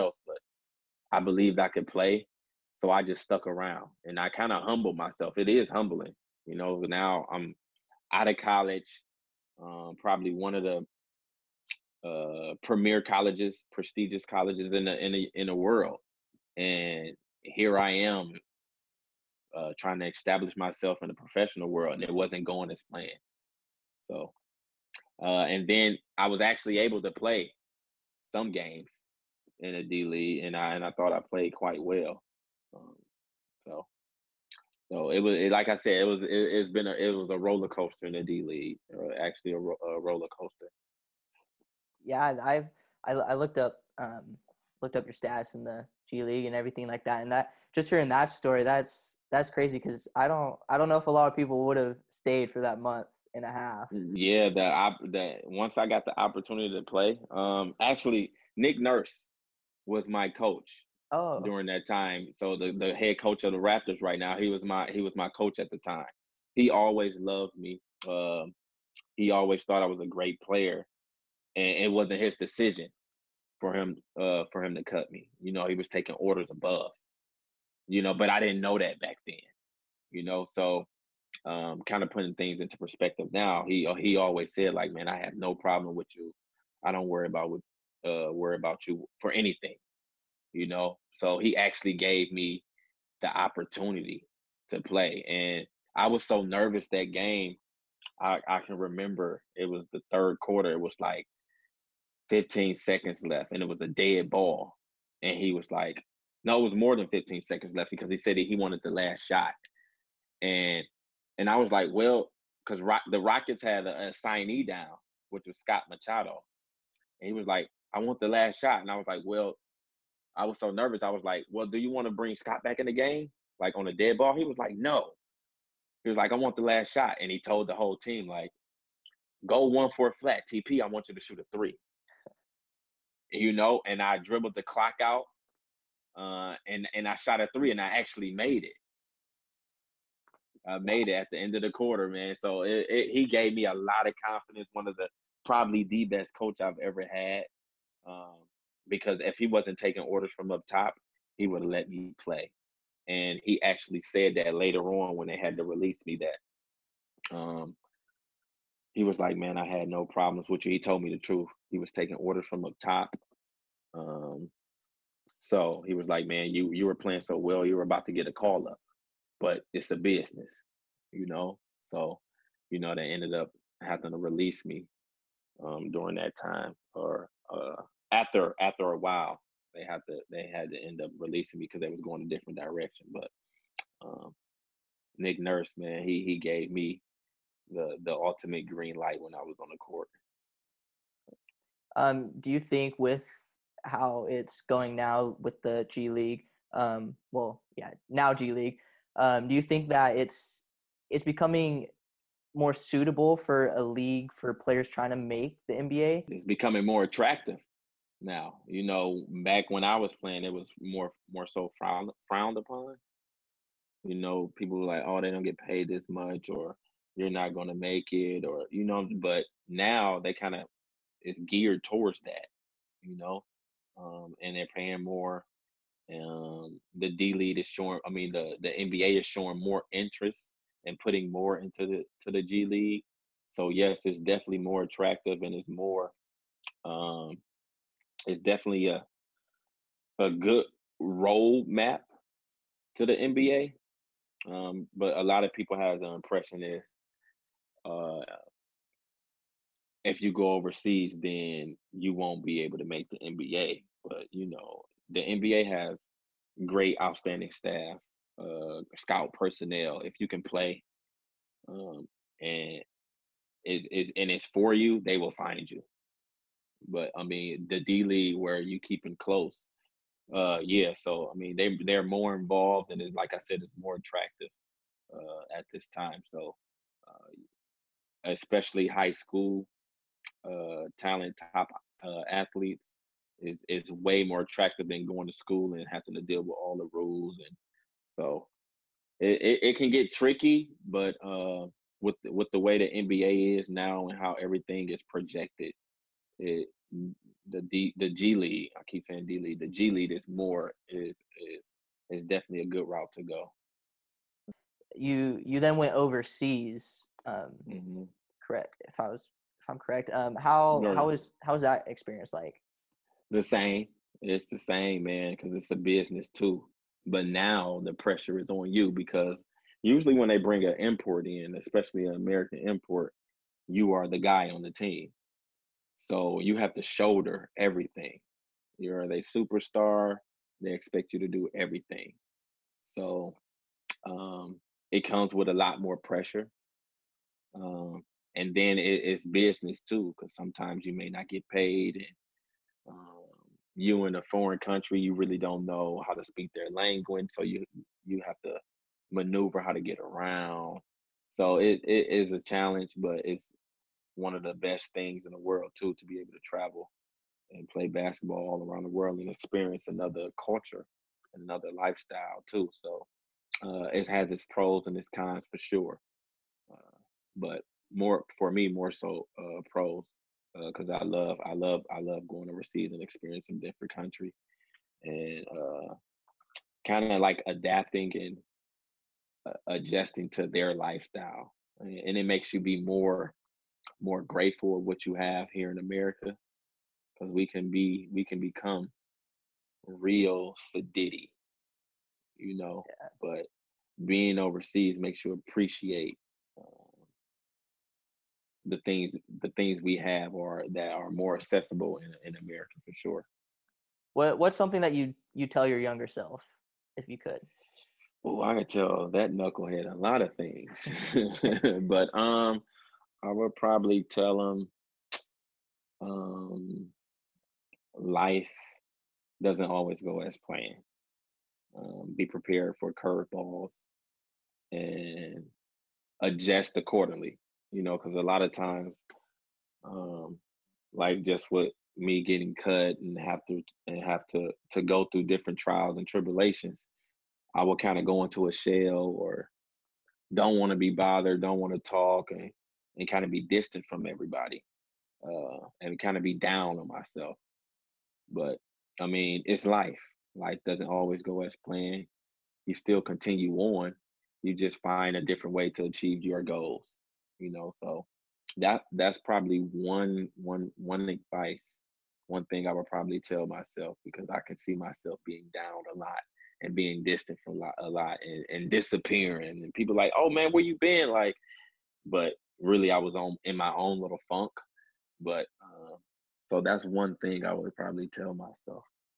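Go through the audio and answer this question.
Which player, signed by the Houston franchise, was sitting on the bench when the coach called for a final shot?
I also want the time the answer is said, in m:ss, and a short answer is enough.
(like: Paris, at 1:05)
Scott Machado, at 1:55.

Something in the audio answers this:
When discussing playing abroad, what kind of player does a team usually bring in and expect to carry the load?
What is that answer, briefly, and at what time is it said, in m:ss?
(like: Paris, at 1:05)
An American import, at 5:22.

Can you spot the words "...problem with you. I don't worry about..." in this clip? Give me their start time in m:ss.
1:25.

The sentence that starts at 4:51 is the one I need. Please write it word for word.
Uh, with with the way the NBA is now and how everything is projected, it, the D, the G League.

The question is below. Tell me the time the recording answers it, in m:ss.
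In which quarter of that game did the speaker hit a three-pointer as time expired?
1:40.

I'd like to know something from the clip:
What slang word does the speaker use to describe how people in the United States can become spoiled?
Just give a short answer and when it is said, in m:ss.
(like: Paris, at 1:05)
Sediddy, at 6:30.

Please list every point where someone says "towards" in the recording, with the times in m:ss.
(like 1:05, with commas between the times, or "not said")
3:41.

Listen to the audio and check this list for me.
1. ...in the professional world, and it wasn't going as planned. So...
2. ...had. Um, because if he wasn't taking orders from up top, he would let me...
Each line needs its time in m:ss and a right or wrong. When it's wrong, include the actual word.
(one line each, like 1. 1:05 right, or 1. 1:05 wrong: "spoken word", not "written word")
1. 0:21 right
2. 2:27 right.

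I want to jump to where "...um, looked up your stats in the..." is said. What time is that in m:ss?
0:43.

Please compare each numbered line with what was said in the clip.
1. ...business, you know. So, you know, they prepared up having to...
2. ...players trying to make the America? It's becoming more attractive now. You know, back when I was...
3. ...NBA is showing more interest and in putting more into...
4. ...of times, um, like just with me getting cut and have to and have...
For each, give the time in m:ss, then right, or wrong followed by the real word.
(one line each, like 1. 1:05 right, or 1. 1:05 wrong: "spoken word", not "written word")
1. 2:49 wrong: "ended", not "prepared"
2. 3:24 wrong: "NBA", not "America"
3. 3:48 right
4. 7:08 right.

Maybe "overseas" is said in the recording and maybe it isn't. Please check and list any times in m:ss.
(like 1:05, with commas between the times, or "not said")
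4:10, 5:05, 6:12, 6:34.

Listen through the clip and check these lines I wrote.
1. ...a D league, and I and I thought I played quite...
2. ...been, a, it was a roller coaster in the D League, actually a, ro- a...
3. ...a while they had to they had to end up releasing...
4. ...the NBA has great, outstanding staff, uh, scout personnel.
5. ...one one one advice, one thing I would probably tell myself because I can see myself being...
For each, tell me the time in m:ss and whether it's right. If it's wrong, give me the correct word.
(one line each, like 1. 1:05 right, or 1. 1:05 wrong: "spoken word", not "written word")
1. 0:29 right
2. 0:36 right
3. 2:58 right
4. 4:15 right
5. 7:39 right.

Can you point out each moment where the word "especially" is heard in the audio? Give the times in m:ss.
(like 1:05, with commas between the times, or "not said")
4:38, 5:21.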